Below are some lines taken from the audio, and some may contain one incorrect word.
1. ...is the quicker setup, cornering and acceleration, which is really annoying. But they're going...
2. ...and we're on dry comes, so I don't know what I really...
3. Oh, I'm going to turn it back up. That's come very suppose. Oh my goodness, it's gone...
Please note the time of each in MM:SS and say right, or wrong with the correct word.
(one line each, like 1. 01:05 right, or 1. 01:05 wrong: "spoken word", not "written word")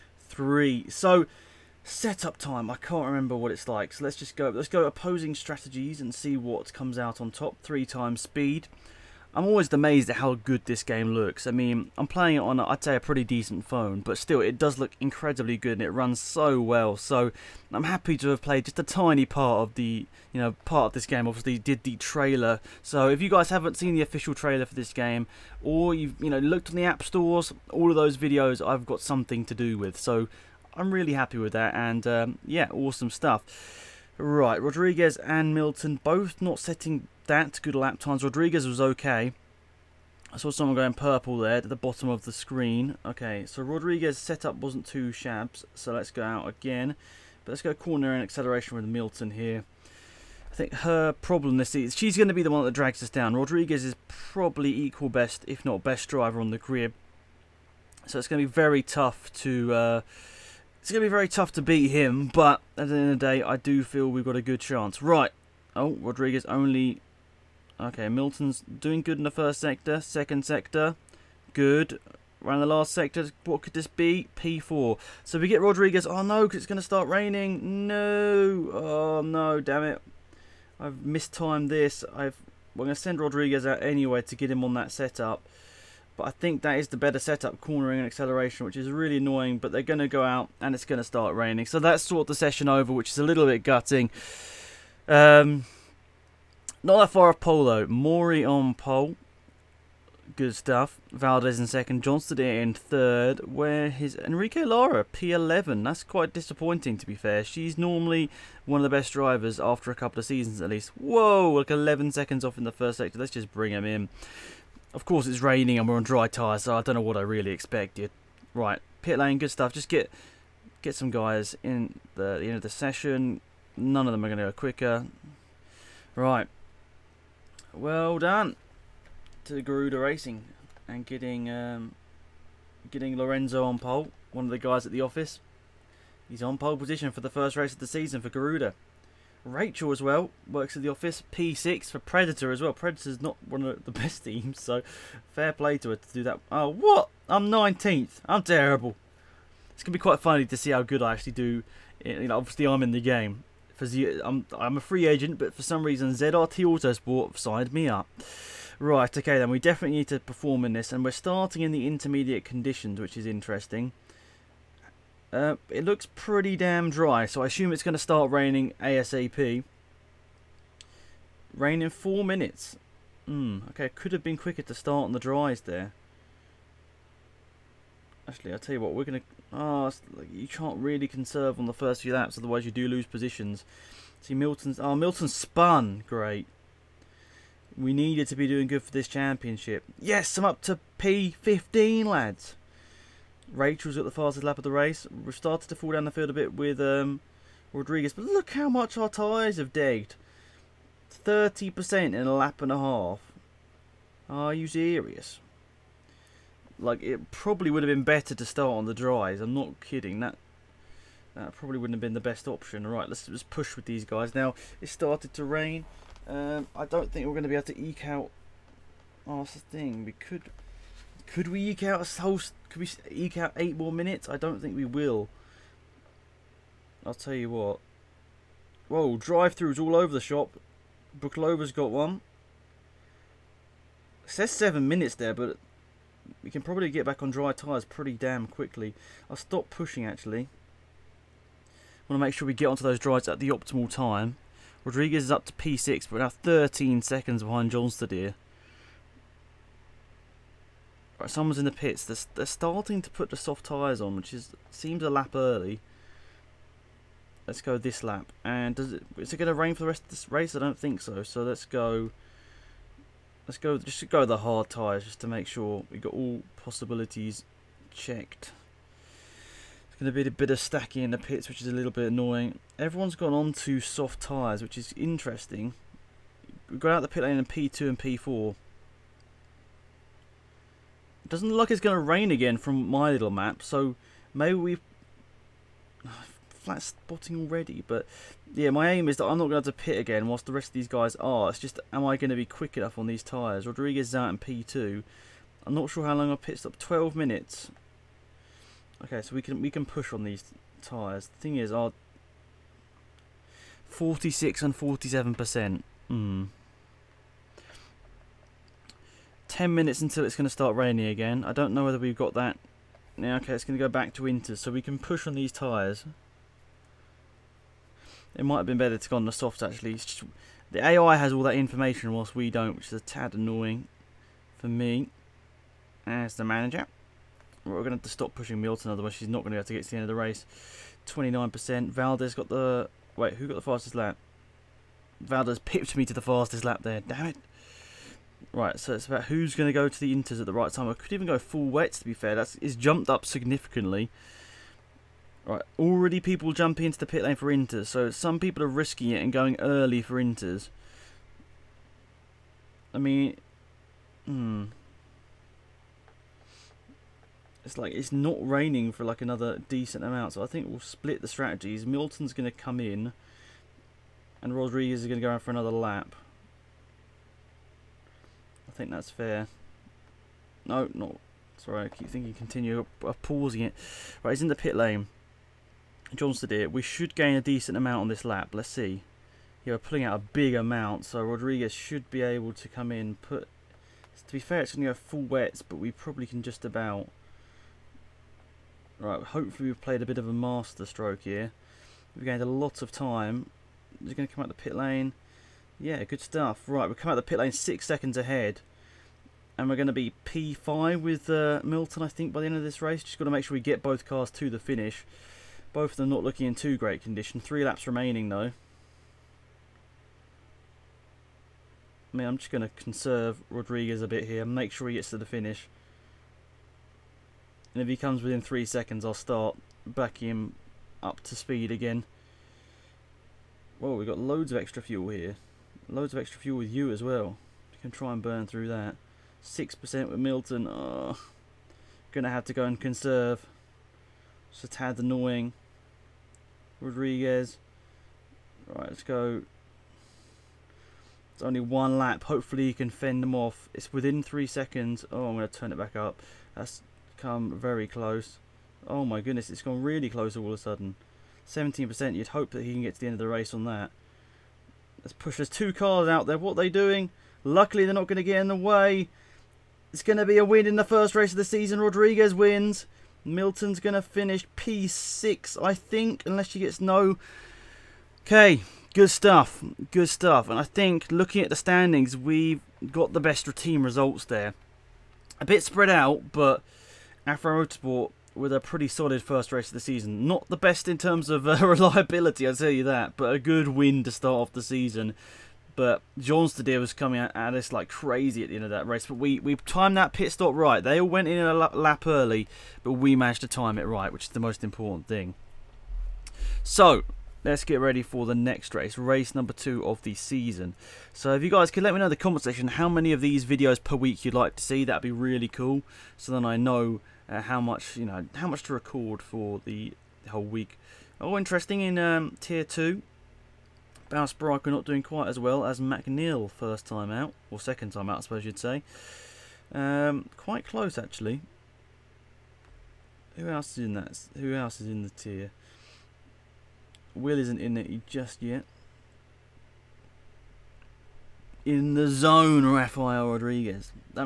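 1. 01:26 wrong: "better", not "quicker"
2. 01:55 wrong: "tyres", not "comes"
3. 07:25 wrong: "close", not "suppose".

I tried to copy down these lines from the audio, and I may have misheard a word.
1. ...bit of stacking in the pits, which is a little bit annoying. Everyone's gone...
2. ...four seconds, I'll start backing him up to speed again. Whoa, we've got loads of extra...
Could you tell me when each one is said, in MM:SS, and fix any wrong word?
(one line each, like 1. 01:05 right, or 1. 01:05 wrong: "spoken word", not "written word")
1. 04:30 right
2. 06:58 wrong: "three", not "four".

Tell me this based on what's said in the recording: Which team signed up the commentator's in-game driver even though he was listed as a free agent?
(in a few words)
ZRT Autosport.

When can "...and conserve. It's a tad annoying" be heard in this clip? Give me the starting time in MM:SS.
07:12.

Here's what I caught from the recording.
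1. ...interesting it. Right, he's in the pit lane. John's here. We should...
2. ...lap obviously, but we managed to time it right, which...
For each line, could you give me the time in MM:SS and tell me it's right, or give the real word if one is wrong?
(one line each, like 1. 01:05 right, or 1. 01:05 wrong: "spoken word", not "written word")
1. 06:13 wrong: "pausing", not "interesting"
2. 08:11 wrong: "early", not "obviously".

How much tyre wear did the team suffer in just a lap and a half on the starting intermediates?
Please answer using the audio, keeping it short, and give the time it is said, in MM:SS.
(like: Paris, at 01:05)
30%, at 03:21.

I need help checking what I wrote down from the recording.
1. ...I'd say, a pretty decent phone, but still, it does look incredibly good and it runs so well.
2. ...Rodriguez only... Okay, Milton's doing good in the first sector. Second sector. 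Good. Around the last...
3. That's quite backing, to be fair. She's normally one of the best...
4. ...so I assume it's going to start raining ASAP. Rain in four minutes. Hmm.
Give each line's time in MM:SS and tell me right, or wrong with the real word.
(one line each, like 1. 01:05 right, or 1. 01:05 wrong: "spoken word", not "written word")
1. 00:12 right
2. 01:05 right
3. 01:45 wrong: "disappointing", not "backing"
4. 02:47 right.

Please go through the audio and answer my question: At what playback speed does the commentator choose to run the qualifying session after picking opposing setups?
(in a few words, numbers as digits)
Three times speed.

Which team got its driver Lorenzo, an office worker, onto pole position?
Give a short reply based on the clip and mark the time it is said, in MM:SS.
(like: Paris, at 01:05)
Garuda Racing, at 02:09.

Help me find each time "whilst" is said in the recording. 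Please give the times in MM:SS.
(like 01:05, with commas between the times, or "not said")
04:50, 05:22.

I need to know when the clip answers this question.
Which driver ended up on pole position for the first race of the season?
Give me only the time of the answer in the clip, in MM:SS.
01:37.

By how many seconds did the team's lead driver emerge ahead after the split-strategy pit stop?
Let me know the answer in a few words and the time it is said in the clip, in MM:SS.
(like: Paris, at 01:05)
6, at 06:37.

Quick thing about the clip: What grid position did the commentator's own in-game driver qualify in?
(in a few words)
19th.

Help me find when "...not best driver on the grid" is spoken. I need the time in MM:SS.
00:55.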